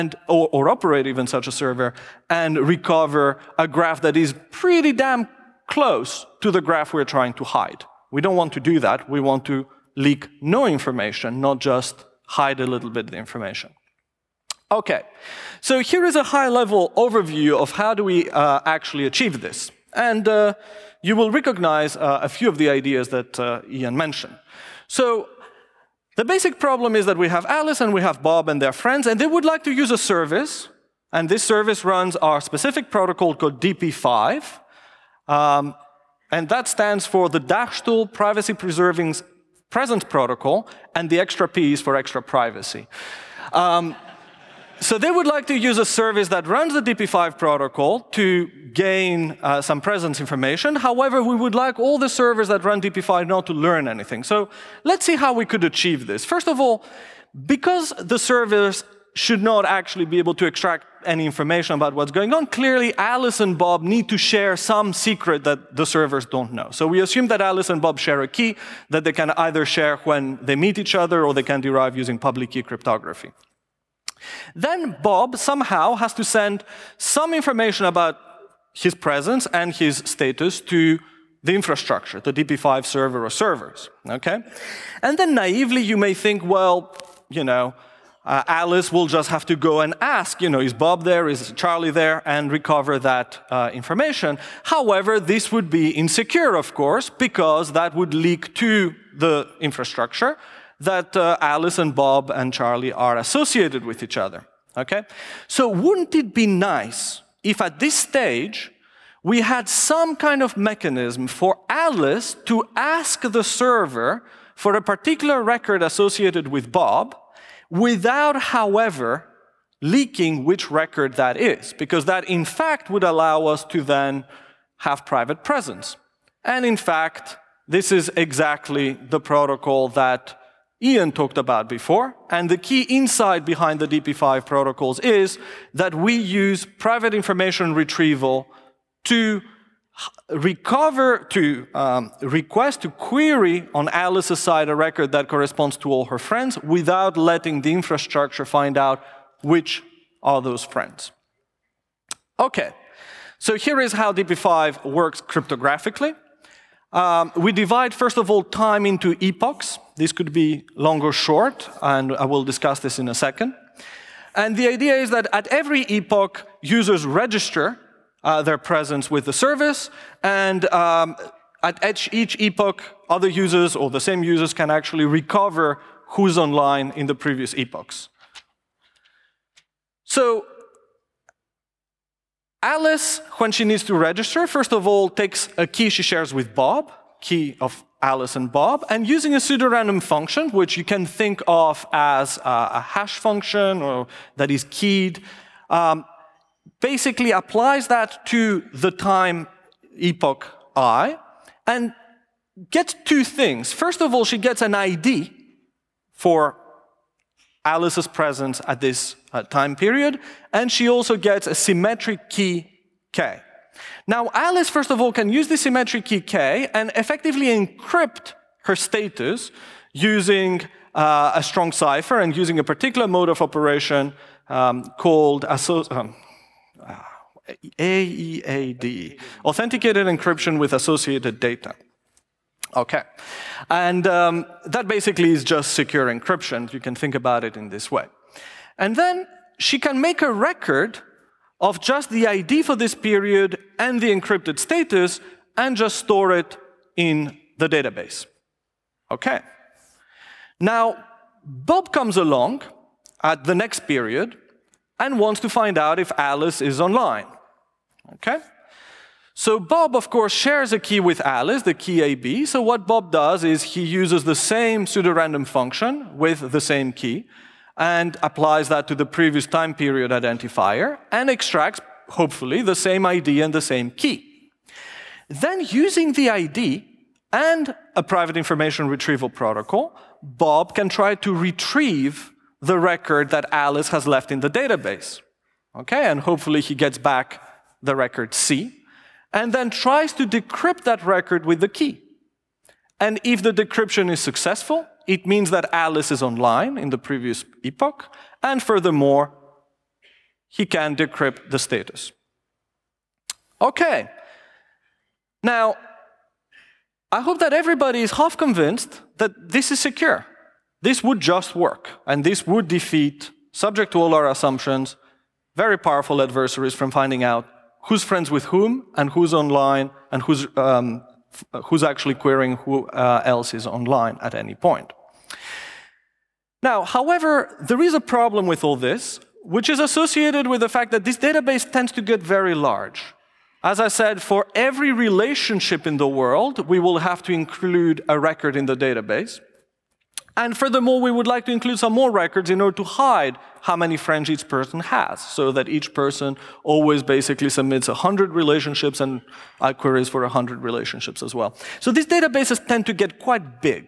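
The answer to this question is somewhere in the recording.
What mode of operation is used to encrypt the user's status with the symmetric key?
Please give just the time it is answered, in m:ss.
3:47.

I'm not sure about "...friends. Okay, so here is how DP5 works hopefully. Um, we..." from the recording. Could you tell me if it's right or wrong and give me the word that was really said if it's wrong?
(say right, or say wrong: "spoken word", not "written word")
wrong: "cryptographically", not "hopefully".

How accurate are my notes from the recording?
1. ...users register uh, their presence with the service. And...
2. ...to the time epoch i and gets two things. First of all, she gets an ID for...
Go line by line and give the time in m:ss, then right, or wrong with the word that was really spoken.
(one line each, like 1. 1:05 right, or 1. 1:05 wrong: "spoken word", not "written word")
1. 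2:46 right
2. 3:18 right.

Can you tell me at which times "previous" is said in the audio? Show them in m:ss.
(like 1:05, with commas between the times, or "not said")
2:57, 4:29, 4:56.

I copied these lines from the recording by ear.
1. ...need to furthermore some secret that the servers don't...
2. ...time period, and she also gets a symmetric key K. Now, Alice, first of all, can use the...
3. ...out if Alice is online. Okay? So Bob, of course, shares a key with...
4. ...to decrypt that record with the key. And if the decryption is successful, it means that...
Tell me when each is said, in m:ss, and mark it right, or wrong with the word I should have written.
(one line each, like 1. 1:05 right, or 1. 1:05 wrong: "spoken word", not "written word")
1. 1:03 wrong: "share", not "furthermore"
2. 3:29 right
3. 4:15 right
4. 4:50 right.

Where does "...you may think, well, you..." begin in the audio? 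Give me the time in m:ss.
1:25.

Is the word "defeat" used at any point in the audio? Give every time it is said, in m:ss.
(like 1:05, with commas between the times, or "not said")
5:12.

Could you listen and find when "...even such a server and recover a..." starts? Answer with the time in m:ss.
0:01.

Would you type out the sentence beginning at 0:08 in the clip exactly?
We don't want to do that.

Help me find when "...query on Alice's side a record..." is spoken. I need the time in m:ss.
2:22.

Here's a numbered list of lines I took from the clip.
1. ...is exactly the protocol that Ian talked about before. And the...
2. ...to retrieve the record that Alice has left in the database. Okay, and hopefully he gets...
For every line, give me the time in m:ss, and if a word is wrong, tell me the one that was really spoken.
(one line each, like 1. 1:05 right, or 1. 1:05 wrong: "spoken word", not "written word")
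1. 2:07 right
2. 4:41 right.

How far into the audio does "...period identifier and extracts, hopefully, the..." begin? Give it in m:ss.
4:29.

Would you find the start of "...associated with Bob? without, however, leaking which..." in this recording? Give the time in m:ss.
1:55.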